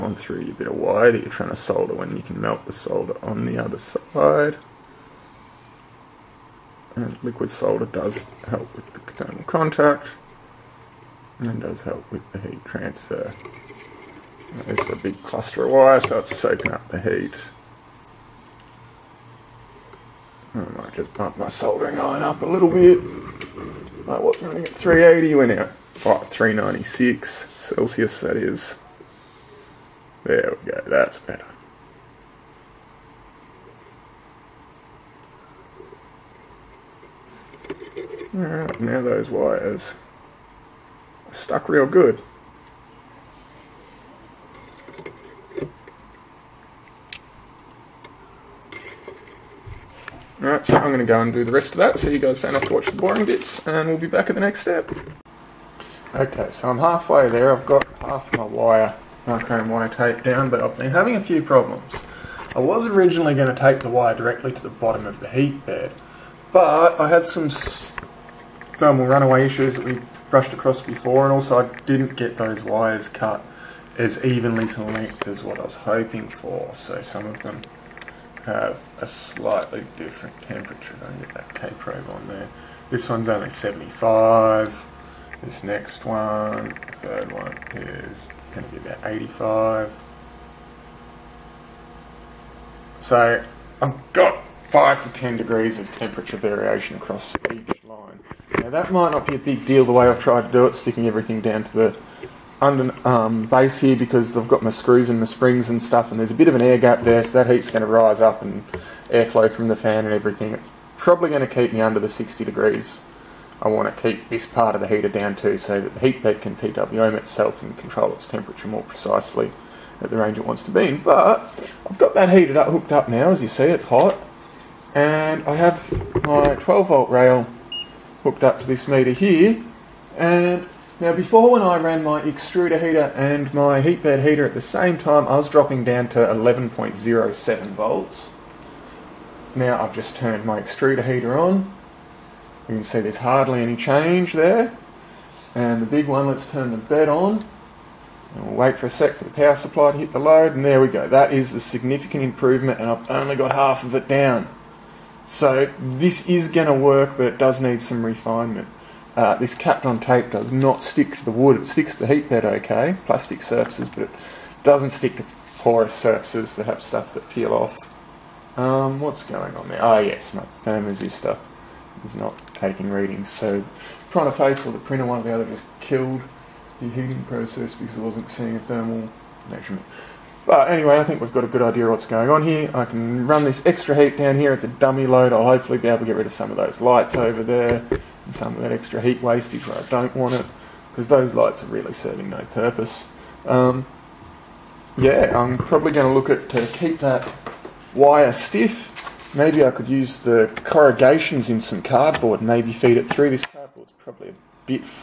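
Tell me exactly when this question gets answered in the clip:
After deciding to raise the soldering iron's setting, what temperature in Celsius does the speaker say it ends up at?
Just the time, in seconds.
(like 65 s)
26 s.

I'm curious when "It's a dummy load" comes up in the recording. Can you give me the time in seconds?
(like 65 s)
184 s.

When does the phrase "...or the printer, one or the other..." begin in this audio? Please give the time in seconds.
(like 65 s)
174 s.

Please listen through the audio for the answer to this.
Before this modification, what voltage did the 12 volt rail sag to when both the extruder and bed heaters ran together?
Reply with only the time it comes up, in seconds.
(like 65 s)
136 s.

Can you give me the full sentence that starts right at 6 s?
And liquid solder does help with the thermal contact and that does help with the heat transfer.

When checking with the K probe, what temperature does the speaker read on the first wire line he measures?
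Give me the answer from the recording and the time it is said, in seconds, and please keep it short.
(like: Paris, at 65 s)
75, at 83 s.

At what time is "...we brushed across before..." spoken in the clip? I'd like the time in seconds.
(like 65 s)
69 s.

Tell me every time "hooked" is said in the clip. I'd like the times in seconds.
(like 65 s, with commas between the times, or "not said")
122 s, 128 s.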